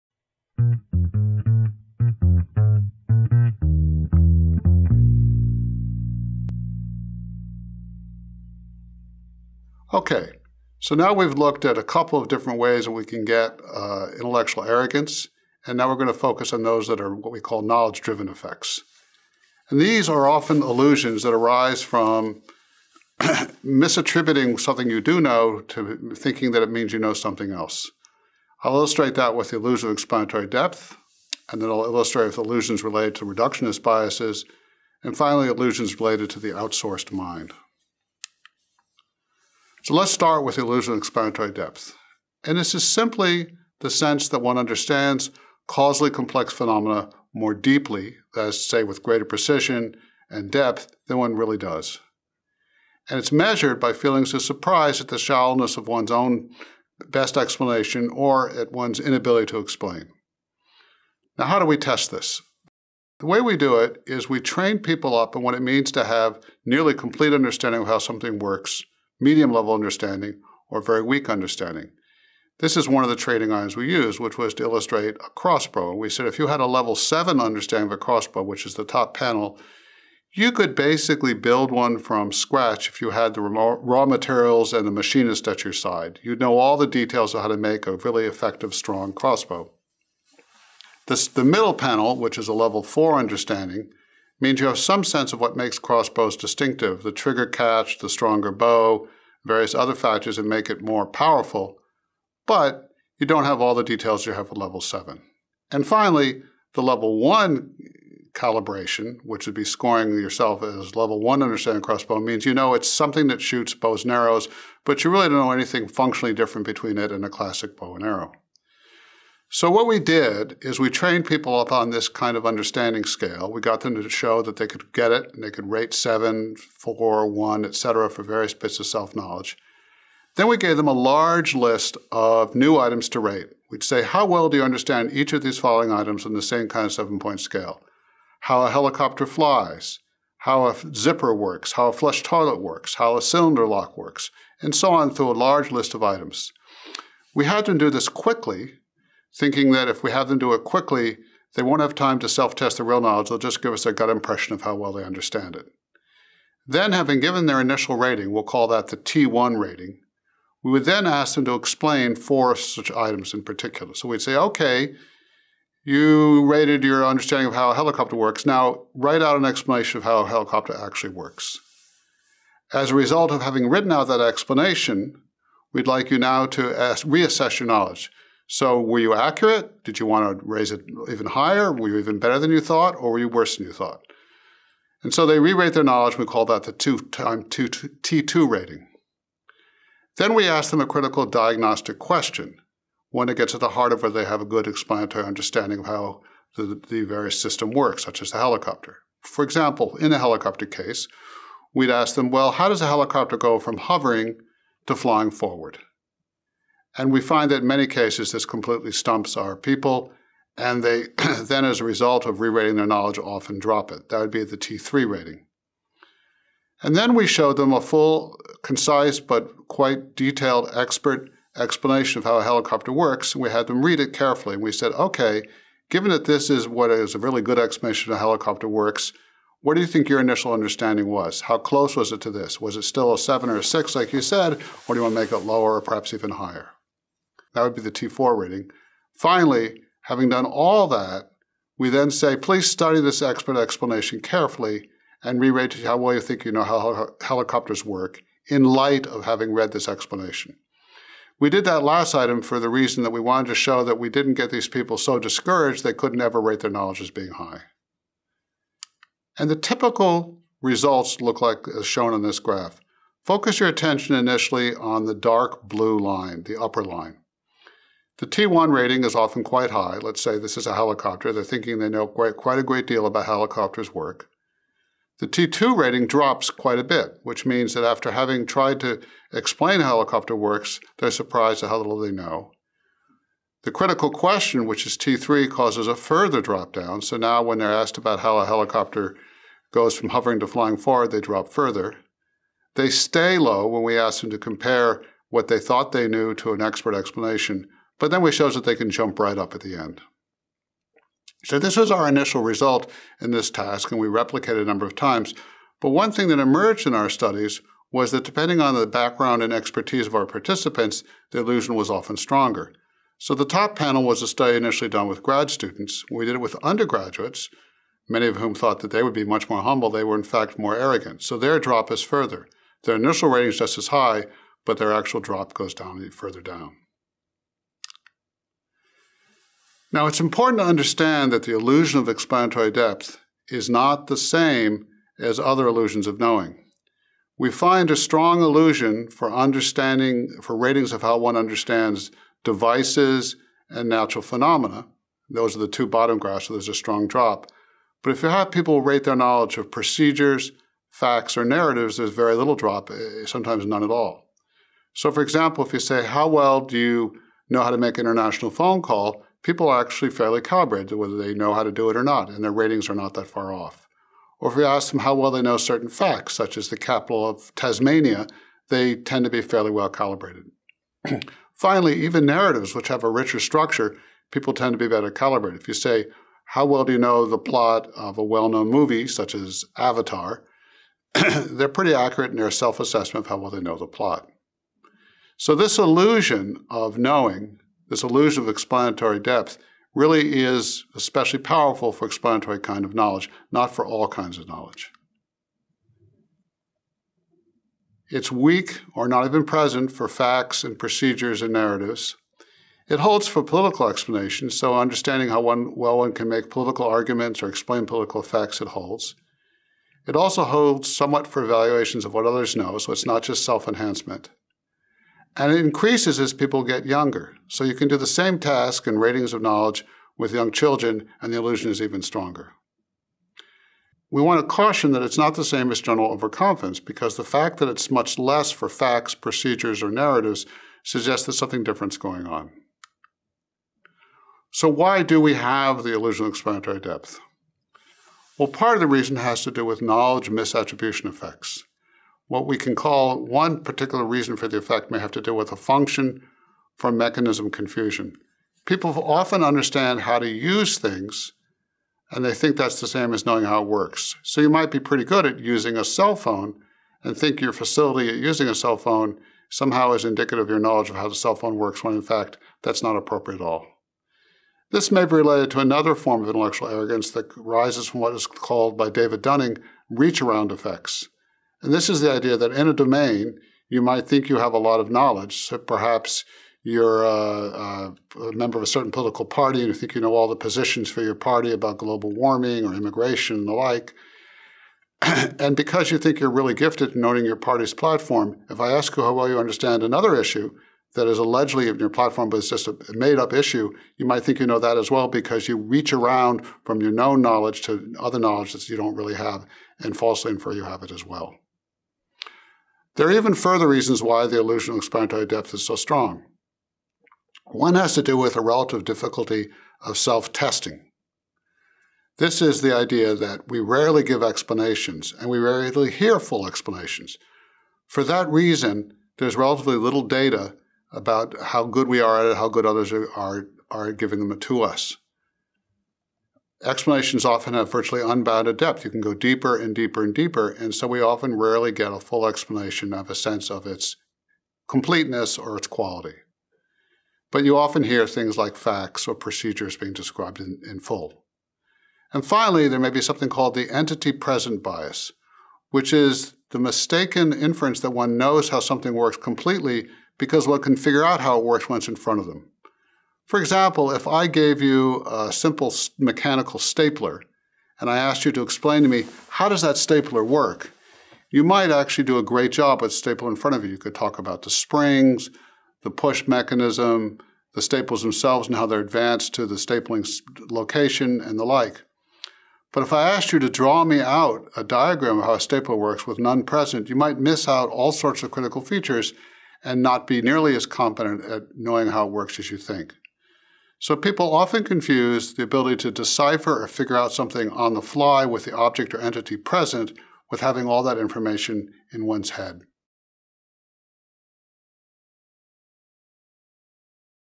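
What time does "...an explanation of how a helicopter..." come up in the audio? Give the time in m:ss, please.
2:49.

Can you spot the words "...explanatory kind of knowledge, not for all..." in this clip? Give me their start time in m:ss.
6:32.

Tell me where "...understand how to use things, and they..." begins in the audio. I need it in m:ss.
7:29.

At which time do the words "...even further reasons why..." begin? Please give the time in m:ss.
8:23.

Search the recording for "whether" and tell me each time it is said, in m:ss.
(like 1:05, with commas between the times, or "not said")
3:14, 6:00.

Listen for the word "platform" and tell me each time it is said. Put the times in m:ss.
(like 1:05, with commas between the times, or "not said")
8:07, 8:11.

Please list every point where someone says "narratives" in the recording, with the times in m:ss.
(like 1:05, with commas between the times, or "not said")
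5:51, 6:12, 6:41, 7:09.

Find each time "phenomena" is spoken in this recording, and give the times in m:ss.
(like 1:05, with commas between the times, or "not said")
0:46, 5:44.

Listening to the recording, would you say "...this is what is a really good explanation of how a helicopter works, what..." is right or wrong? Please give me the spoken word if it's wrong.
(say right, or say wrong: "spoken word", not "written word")
right.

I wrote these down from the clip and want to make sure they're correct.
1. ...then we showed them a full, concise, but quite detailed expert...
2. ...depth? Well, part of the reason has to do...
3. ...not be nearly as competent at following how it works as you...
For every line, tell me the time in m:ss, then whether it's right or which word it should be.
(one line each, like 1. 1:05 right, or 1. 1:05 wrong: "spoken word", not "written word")
1. 3:36 right
2. 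7:16 right
3. 9:39 wrong: "knowing", not "following".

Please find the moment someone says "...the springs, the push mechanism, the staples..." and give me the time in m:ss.
9:24.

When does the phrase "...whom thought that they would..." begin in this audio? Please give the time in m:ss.
5:18.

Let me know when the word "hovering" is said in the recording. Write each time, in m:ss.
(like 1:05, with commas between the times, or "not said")
3:23, 4:50.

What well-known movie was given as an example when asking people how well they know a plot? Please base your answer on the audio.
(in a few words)
Avatar.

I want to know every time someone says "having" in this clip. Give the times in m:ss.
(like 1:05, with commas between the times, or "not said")
2:36, 2:53, 4:00, 4:09, 4:38, 9:50.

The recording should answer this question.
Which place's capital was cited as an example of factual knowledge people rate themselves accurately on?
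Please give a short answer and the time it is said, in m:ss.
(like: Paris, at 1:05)
Tasmania, at 6:07.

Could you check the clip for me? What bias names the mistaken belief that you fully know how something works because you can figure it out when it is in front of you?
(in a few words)
Entity present bias.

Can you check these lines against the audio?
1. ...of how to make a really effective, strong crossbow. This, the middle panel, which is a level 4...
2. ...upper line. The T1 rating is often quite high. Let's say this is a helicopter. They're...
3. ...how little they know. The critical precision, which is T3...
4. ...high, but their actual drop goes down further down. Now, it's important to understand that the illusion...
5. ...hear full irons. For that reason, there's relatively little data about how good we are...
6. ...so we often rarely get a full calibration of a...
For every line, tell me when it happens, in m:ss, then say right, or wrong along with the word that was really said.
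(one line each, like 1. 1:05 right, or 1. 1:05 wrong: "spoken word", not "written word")
1. 1:27 right
2. 4:26 right
3. 4:41 wrong: "question", not "precision"
4. 5:23 right
5. 8:35 wrong: "explanations", not "irons"
6. 8:50 wrong: "explanation", not "calibration".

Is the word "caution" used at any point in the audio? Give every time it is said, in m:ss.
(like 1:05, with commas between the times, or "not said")
7:04.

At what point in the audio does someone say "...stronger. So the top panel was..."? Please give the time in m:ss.
5:12.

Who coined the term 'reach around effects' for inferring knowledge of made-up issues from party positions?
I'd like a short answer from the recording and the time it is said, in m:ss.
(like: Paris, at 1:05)
David Dunning, at 7:48.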